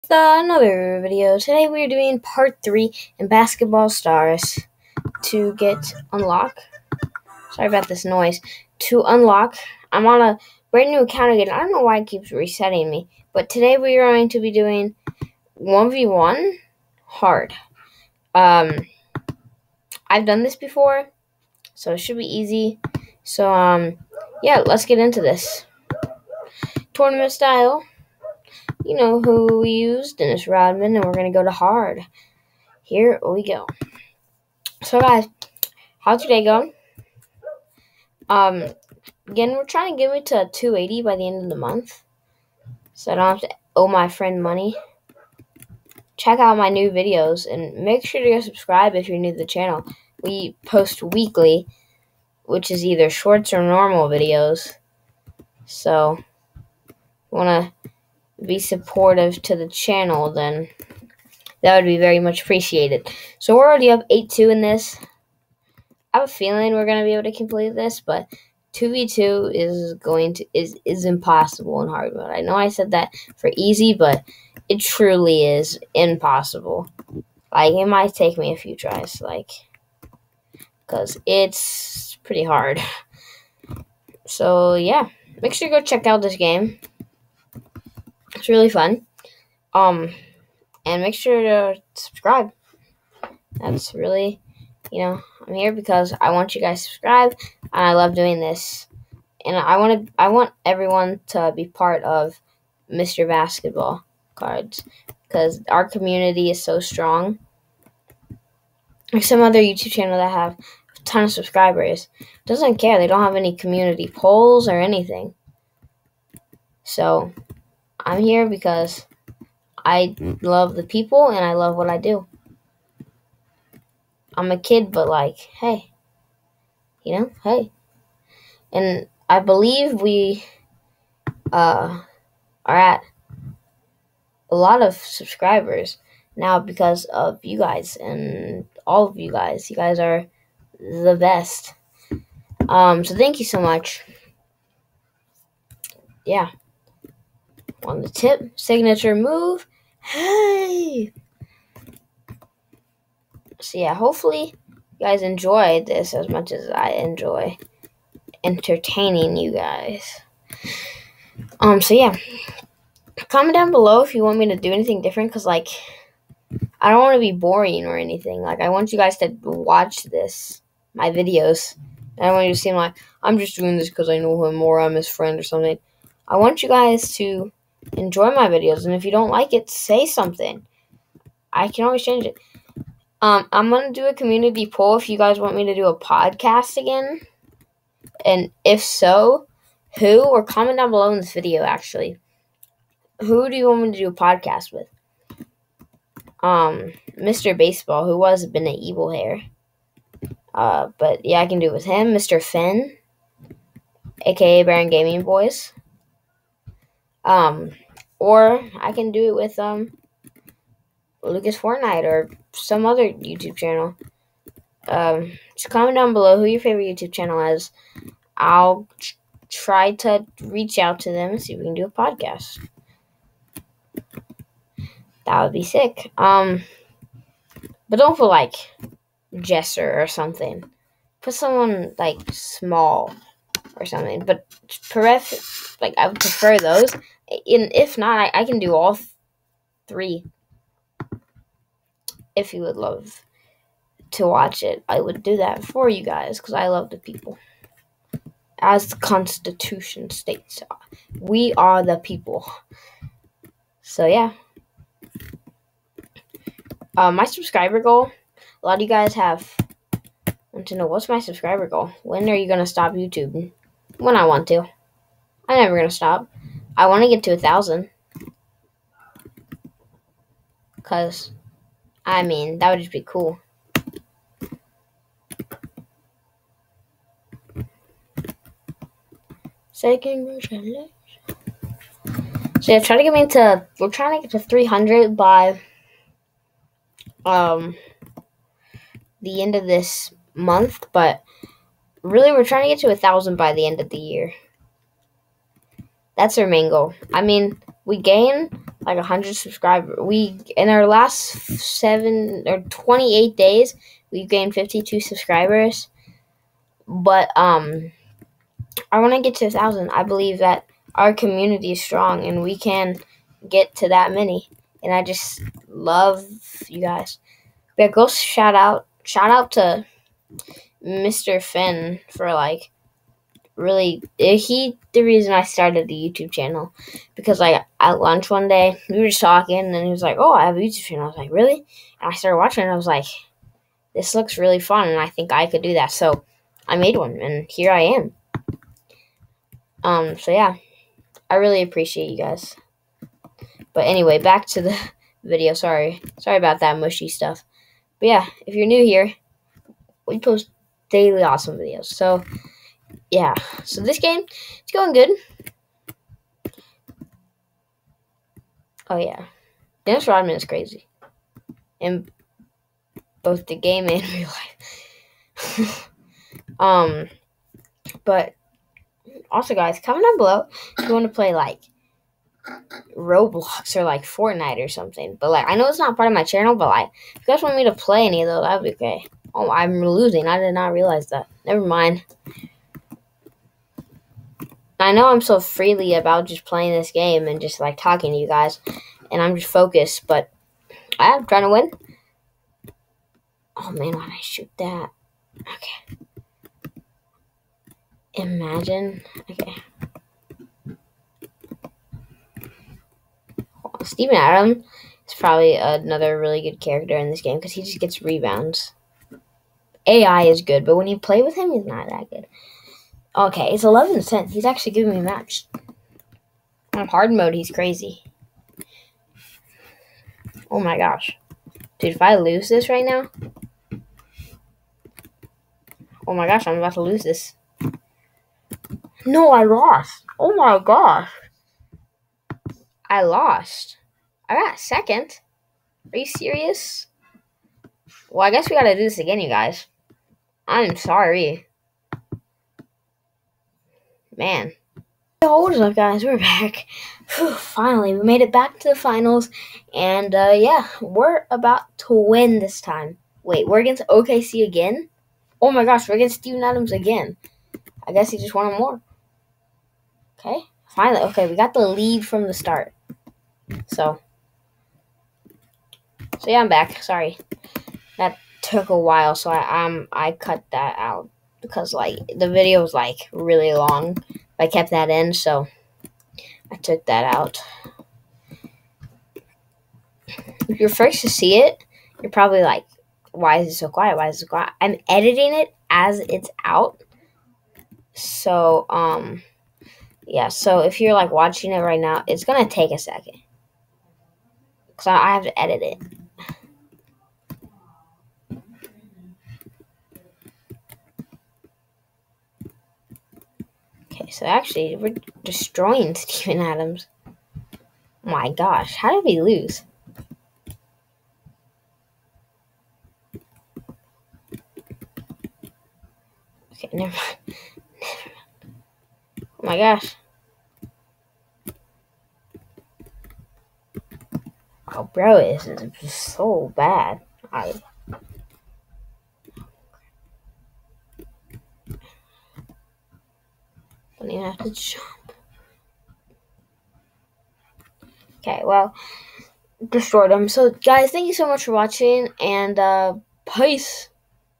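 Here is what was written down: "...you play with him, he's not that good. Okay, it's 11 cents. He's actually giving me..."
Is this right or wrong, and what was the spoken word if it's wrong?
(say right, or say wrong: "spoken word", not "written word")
right.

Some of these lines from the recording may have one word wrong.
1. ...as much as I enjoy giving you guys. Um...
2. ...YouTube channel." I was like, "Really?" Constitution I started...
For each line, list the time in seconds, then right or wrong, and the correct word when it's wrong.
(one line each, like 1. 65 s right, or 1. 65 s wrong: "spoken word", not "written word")
1. 156 s wrong: "entertaining", not "giving"
2. 330 s wrong: "And", not "Constitution".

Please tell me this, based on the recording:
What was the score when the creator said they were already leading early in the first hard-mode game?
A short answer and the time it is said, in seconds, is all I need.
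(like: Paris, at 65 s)
8-2, at 64 s.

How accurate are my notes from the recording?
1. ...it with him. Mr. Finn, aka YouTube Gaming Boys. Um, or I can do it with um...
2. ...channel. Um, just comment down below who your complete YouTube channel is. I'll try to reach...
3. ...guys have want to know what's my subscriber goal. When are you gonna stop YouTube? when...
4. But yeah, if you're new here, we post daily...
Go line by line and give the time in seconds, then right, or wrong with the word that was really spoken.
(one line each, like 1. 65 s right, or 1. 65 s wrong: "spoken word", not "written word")
1. 201 s wrong: "Baron", not "YouTube"
2. 213 s wrong: "favorite", not "complete"
3. 258 s right
4. 347 s right.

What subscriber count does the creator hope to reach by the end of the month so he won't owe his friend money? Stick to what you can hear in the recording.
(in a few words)
280.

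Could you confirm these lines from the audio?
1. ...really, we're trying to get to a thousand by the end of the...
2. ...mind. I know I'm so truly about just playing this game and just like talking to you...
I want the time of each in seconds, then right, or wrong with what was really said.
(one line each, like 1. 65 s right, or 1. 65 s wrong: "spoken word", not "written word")
1. 292 s right
2. 381 s wrong: "freely", not "truly".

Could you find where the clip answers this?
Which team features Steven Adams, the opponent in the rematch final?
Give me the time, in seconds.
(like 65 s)
453 s.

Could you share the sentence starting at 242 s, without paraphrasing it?
If you would love to watch it, I would do that for you guys because I love the people.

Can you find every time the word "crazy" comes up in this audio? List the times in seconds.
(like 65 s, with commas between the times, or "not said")
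360 s, 417 s.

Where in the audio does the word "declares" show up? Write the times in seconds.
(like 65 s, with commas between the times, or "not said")
not said.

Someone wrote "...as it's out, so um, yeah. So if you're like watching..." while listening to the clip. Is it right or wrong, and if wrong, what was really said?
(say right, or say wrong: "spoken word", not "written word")
right.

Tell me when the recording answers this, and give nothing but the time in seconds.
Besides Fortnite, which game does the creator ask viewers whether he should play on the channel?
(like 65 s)
372 s.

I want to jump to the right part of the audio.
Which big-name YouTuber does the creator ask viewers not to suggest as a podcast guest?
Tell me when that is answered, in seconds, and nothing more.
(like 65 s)
229 s.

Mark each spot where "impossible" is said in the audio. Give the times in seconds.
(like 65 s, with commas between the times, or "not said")
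71 s, 75 s.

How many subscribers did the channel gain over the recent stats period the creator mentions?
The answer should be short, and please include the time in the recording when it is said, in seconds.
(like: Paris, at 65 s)
52, at 304 s.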